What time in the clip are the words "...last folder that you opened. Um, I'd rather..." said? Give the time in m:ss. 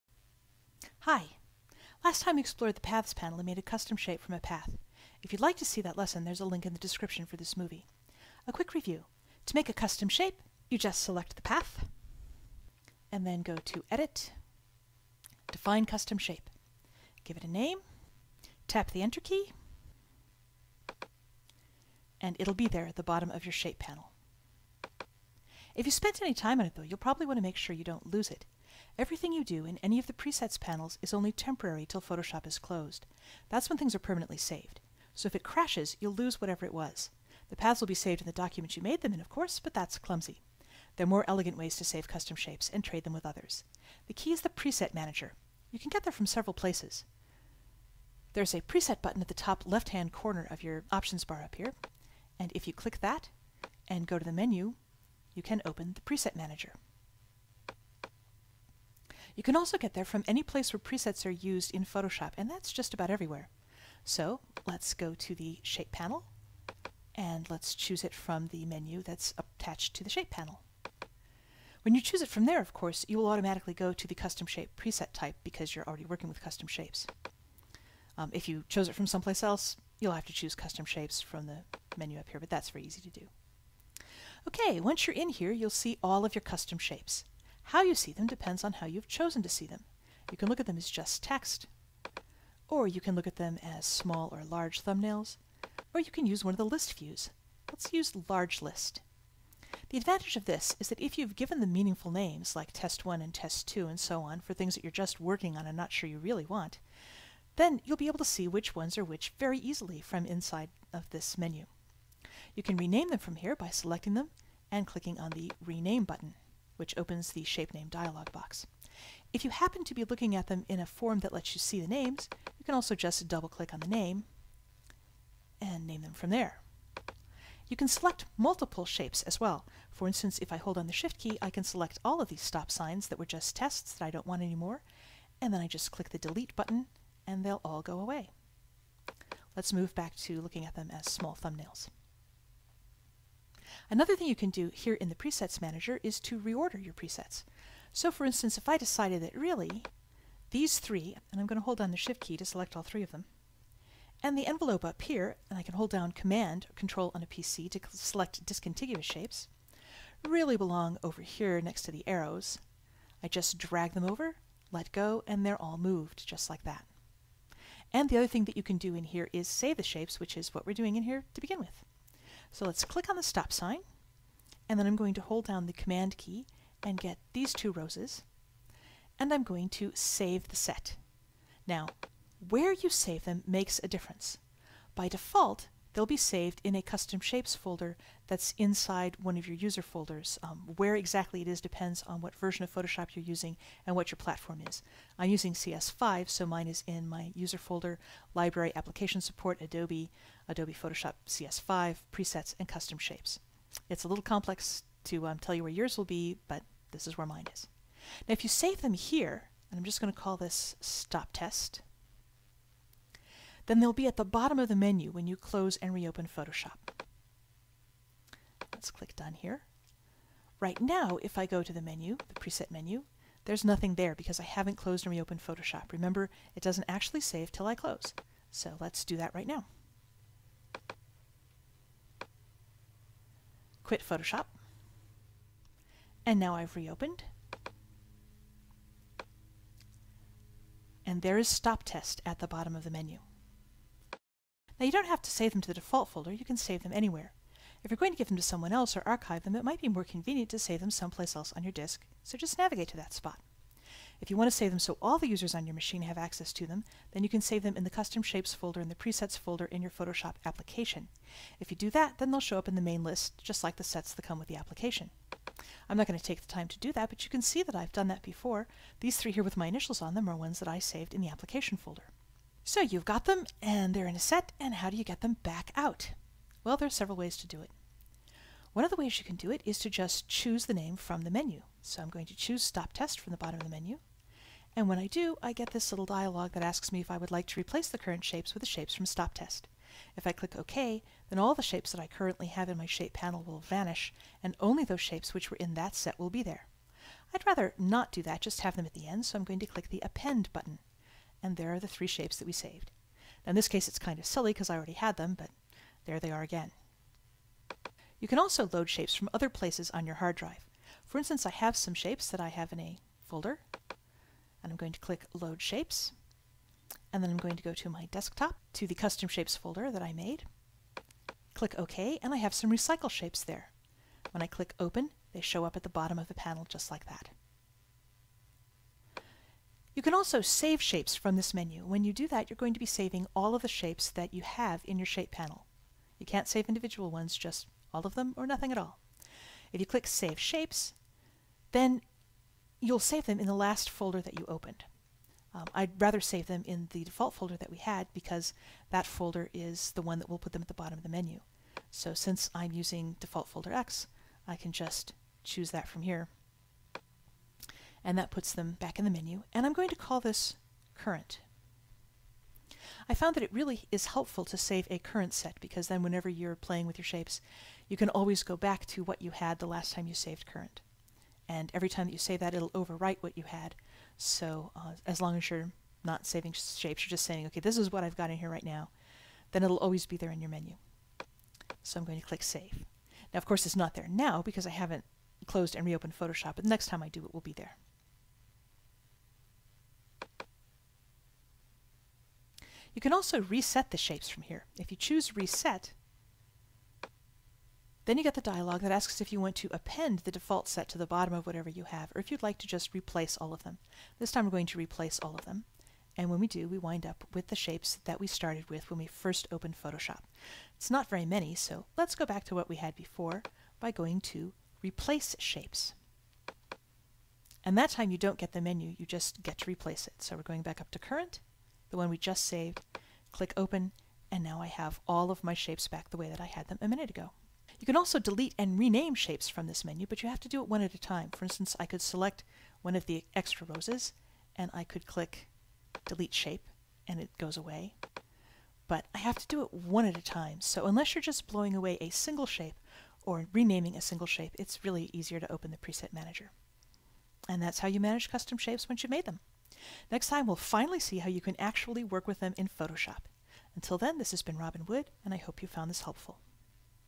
5:43.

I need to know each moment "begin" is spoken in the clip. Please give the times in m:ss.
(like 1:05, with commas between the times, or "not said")
2:51.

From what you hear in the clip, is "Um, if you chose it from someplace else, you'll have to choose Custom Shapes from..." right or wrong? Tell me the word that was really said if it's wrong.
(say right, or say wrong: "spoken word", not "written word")
right.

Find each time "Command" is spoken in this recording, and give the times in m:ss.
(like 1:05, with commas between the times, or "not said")
2:36, 2:55.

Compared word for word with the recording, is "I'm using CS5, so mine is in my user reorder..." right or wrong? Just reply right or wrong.
wrong.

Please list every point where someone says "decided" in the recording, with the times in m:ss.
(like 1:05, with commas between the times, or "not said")
2:28.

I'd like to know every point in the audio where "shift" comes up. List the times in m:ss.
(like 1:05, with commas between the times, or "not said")
2:11, 2:31.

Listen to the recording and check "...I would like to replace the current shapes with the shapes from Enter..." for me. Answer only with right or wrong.
wrong.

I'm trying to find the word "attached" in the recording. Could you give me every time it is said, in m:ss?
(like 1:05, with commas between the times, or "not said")
1:09.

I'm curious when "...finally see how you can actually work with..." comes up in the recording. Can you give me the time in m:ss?
7:30.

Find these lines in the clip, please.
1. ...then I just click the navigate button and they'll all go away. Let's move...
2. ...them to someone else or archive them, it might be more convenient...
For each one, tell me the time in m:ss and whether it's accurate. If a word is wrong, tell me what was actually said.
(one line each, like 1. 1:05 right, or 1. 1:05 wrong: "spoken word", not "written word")
1. 2:15 wrong: "delete", not "navigate"
2. 4:08 right.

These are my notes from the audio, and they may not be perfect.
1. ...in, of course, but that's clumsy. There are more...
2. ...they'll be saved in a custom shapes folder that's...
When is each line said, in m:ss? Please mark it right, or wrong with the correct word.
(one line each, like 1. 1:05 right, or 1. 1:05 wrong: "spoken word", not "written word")
1. 0:39 right
2. 3:05 right.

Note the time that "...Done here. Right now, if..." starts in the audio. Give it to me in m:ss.
3:39.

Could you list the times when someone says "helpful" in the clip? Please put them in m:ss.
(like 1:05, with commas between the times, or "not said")
6:04, 7:36.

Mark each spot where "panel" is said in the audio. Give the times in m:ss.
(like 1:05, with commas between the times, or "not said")
0:03, 0:23, 0:30, 1:05, 1:10, 4:53, 5:26, 5:35.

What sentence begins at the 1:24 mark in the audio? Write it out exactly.
Okay, once you're in here, you'll see all of your custom shapes.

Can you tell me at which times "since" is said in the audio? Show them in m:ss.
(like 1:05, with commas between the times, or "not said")
5:52.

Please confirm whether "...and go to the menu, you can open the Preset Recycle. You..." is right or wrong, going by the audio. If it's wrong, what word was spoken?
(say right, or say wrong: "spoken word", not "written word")
wrong: "Manager", not "Recycle".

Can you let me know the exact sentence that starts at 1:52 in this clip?
You can rename them from here by selecting them and clicking on the Rename button which opens the shape name dialog box.